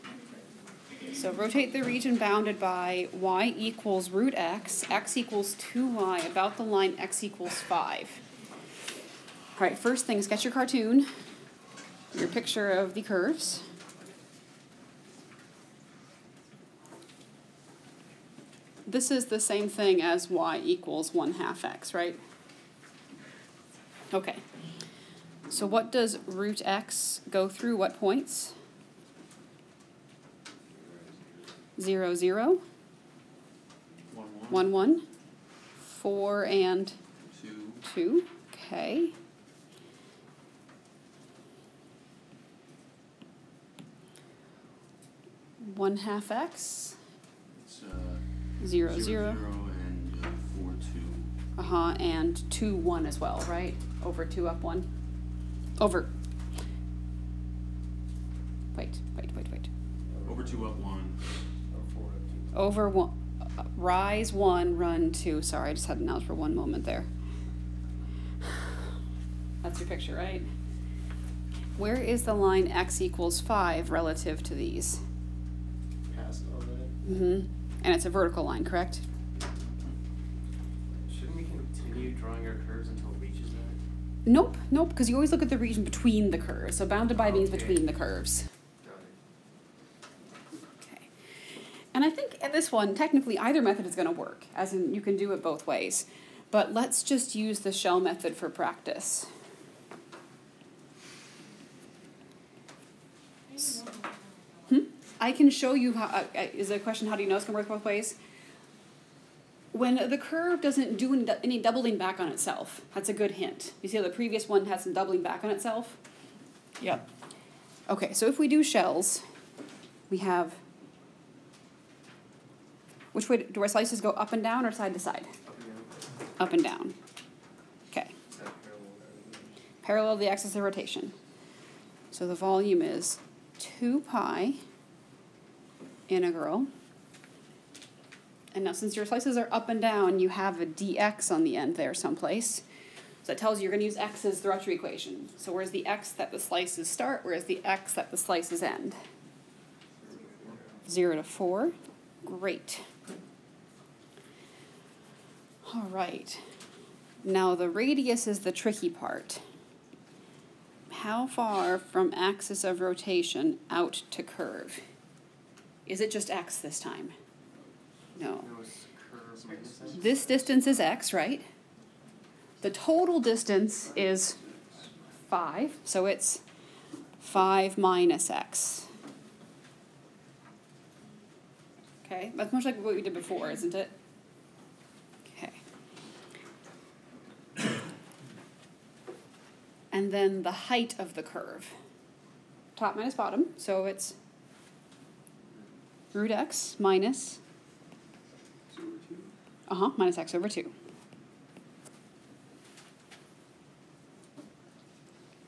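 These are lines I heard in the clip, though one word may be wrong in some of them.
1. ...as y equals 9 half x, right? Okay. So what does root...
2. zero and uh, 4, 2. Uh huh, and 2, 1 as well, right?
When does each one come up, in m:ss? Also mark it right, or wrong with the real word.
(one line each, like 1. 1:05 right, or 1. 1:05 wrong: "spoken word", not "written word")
1. 0:20 wrong: "1", not "9"
2. 0:48 right.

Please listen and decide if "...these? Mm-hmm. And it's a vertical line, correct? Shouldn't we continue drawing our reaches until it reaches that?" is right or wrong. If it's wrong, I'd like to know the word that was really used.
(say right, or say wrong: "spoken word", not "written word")
wrong: "curves", not "reaches".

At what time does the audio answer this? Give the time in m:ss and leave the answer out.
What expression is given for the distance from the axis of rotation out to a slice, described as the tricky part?
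2:57.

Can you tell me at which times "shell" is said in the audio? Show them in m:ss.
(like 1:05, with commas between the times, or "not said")
1:37, 1:58.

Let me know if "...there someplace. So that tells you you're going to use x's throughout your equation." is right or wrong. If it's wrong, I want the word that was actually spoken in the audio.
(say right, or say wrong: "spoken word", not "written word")
right.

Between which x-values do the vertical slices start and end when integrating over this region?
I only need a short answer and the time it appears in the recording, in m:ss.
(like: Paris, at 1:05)
0 to 4, at 2:30.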